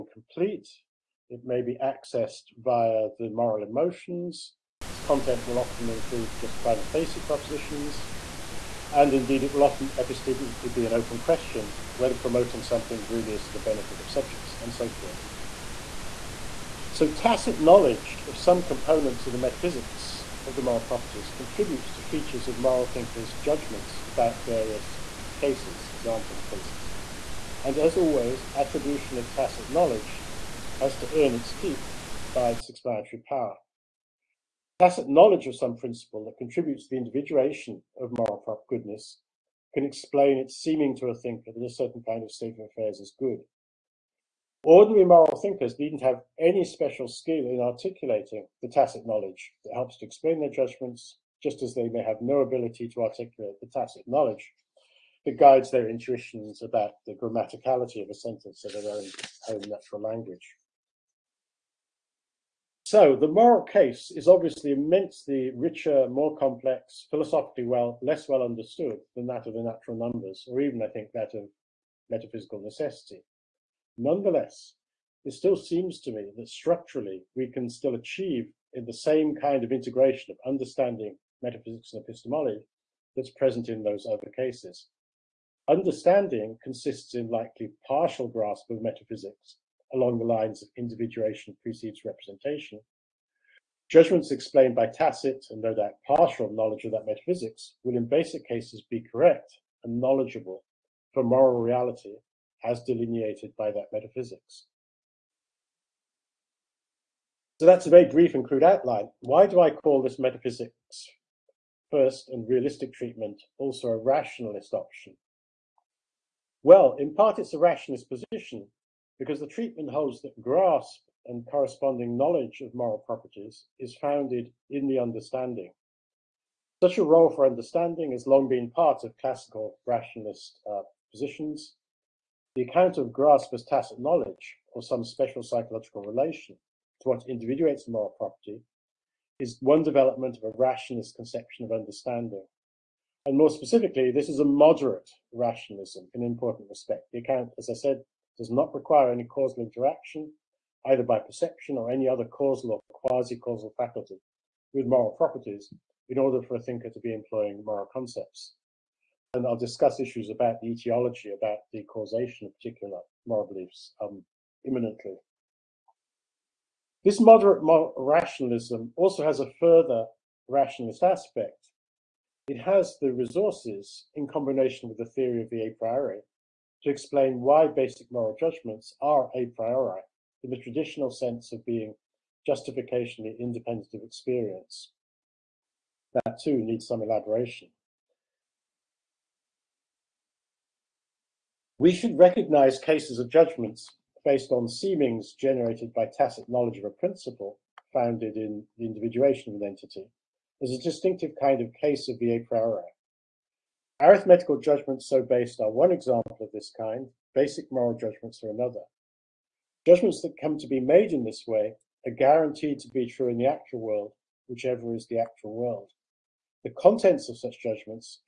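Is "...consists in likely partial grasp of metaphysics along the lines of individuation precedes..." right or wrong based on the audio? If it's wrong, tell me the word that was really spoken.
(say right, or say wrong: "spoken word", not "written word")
right.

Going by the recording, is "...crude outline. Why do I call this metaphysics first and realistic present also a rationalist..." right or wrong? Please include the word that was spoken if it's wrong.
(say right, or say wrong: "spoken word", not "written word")
wrong: "treatment", not "present".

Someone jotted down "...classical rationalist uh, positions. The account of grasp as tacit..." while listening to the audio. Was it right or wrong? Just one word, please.
right.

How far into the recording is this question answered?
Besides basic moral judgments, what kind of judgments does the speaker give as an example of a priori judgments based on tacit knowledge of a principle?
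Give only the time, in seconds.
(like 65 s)
204 s.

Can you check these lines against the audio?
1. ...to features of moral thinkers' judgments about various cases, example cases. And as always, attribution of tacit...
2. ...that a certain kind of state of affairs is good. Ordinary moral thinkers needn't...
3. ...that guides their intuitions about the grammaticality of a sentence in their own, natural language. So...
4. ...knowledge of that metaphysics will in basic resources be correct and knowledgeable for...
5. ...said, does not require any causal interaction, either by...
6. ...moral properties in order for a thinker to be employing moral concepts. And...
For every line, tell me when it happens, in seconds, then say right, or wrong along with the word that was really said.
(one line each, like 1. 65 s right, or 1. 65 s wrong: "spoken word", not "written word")
1. 21 s right
2. 41 s right
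3. 55 s right
4. 96 s wrong: "cases", not "resources"
5. 147 s right
6. 154 s right.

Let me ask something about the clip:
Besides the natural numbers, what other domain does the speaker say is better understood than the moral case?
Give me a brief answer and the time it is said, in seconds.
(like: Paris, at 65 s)
metaphysical necessity, at 72 s.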